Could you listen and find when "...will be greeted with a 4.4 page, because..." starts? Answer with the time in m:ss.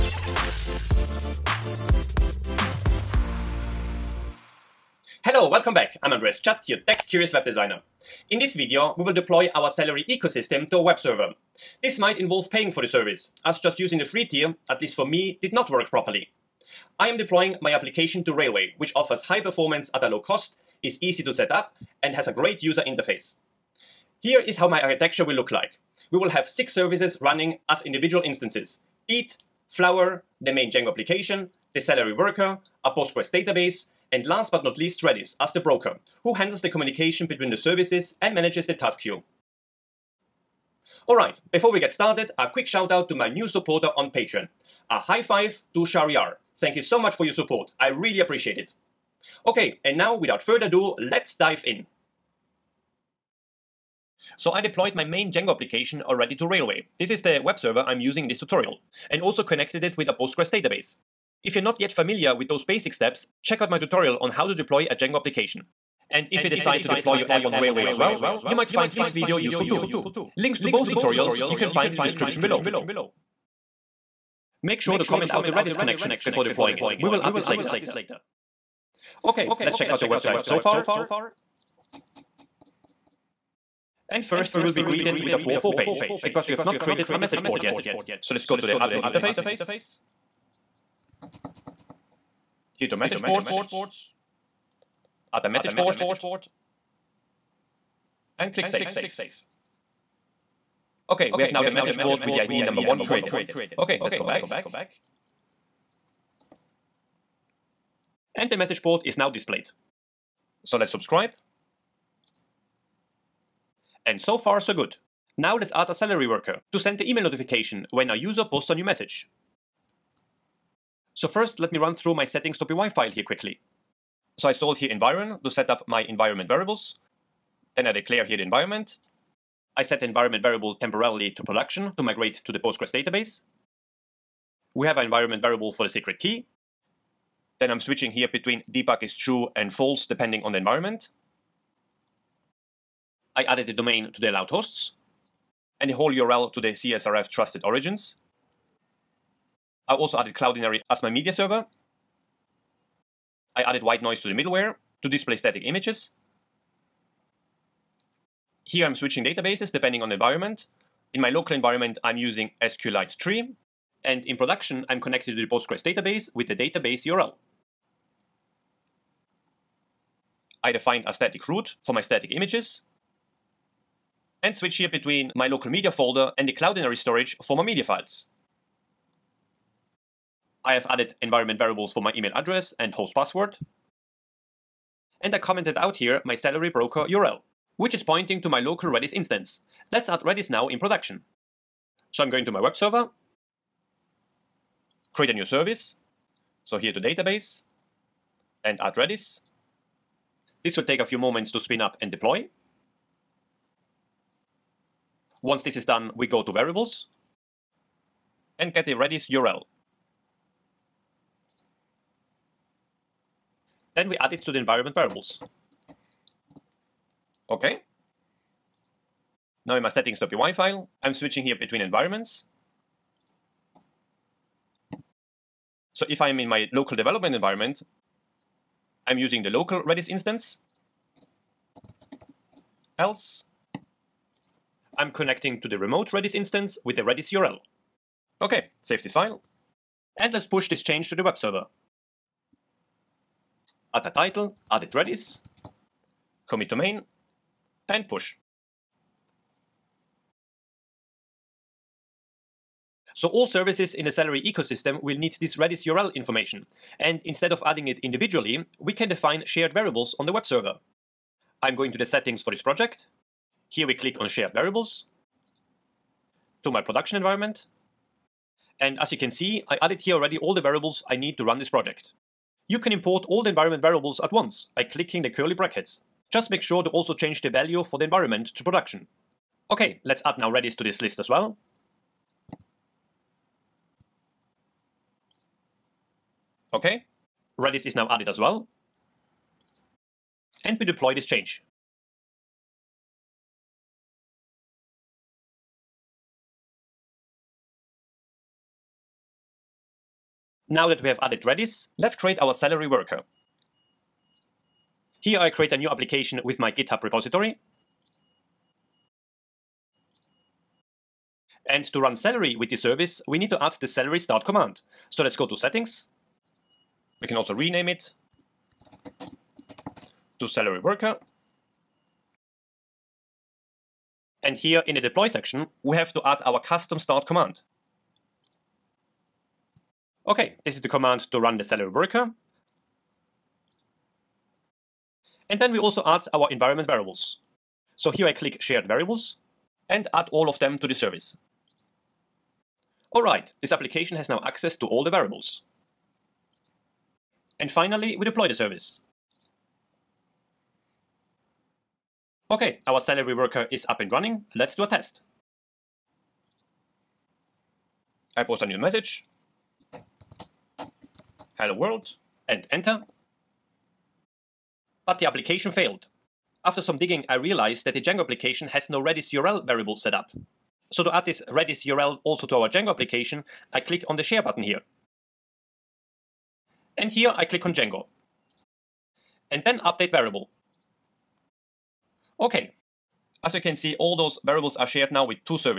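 1:24.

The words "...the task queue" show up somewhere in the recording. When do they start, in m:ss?
0:38.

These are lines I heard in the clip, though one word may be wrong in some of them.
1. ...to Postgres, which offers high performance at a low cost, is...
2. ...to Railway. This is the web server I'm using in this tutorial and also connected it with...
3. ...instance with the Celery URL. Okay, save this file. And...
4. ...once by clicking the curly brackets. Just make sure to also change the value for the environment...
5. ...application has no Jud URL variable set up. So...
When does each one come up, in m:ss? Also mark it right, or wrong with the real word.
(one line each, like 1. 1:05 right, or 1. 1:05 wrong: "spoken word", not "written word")
1. 0:18 wrong: "Railway", not "Postgres"
2. 0:56 right
3. 3:56 wrong: "Redis", not "Celery"
4. 4:34 right
5. 6:08 wrong: "Redis", not "Jud".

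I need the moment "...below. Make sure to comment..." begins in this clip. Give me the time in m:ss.
1:12.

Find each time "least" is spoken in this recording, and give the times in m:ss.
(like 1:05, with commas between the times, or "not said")
0:14, 0:34.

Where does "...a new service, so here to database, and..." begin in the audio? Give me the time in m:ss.
3:15.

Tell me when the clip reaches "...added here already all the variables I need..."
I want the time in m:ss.
4:29.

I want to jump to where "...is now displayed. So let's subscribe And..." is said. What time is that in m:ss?
1:49.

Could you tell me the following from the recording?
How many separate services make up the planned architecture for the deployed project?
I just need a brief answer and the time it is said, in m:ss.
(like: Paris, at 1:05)
6, at 0:26.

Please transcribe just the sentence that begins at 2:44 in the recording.
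And in production, I'm connected to the Postgres database with the database URL.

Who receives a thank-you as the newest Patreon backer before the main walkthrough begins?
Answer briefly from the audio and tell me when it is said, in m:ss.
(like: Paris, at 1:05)
Shariar, at 0:45.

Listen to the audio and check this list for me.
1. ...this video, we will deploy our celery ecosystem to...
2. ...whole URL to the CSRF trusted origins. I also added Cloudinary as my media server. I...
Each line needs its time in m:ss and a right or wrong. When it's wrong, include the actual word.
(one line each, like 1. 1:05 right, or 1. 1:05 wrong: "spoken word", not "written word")
1. 0:08 right
2. 2:25 right.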